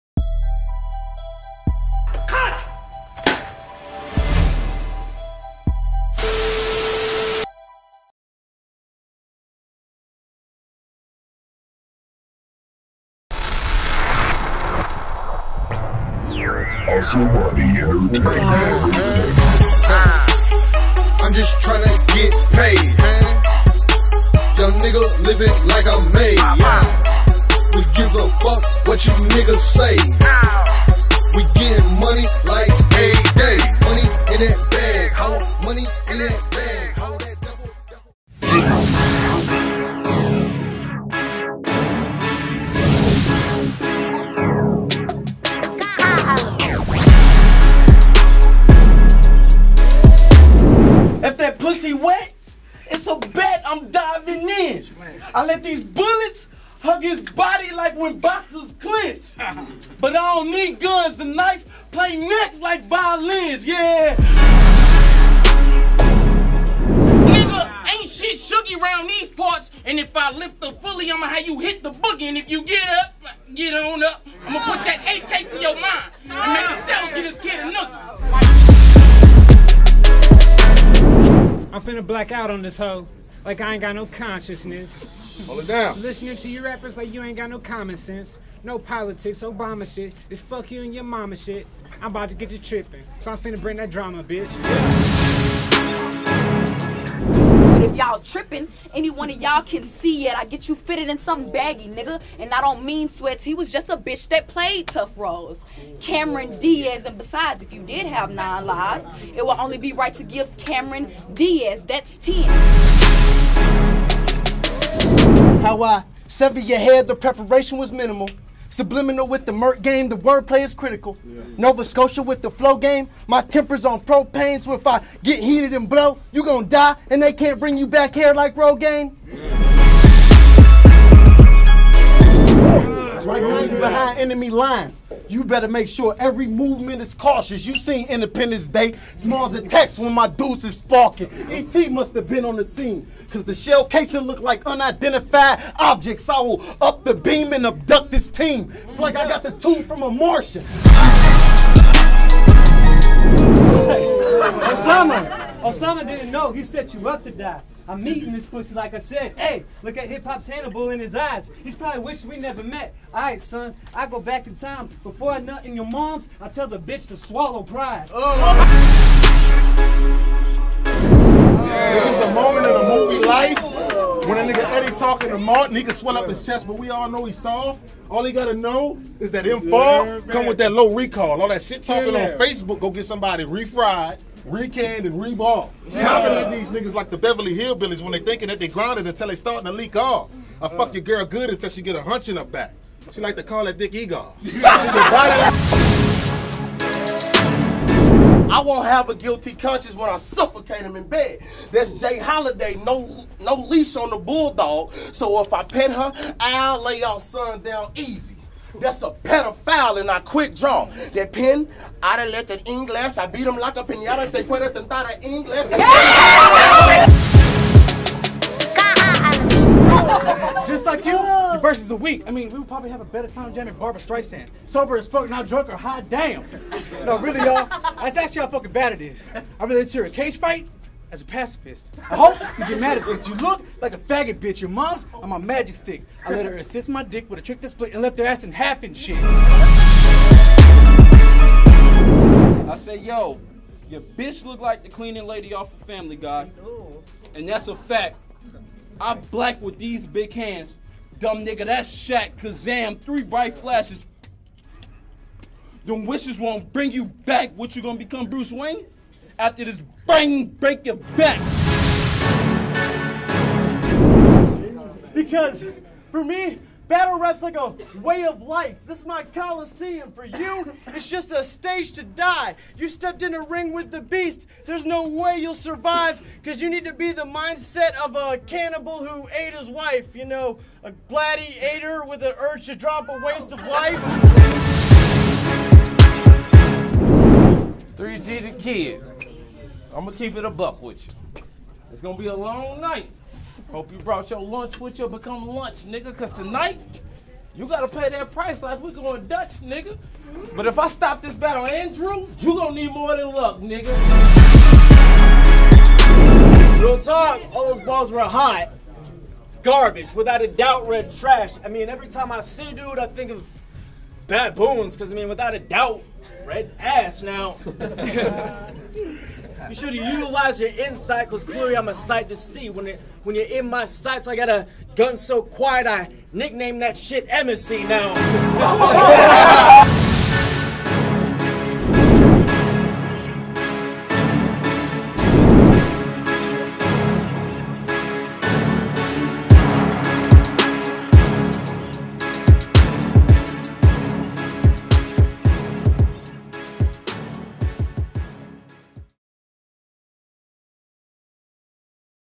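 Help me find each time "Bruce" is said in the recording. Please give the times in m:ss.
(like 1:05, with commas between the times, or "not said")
4:18.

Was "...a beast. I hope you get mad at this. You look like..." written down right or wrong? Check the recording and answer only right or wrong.
wrong.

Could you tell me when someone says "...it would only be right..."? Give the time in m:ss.
1:49.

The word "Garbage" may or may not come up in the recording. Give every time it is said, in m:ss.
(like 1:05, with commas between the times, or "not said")
5:09.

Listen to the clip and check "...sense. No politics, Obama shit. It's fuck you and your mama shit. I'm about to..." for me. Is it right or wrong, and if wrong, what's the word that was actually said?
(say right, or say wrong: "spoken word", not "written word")
right.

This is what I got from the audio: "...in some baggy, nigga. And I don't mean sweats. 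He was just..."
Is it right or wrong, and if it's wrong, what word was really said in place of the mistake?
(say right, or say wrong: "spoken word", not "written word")
right.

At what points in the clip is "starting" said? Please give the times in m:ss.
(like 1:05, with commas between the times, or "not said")
3:09.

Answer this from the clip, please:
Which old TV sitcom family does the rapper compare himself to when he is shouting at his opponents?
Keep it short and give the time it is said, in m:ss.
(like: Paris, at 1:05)
The Beverly Hillbillies, at 3:07.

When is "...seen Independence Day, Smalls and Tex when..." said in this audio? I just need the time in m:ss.
2:17.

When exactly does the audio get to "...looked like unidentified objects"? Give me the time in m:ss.
2:24.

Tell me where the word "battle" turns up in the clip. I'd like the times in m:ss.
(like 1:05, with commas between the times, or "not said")
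4:26, 5:01.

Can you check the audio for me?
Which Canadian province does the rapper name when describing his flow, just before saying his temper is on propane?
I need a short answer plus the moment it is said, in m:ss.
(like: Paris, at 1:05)
Nova Scotia, at 2:01.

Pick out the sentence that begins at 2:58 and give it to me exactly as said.
All he gotta know is that m fall come with that low recall.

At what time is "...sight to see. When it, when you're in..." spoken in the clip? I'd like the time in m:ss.
5:21.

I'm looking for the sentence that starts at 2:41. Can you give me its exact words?
He's probably wishing we never met.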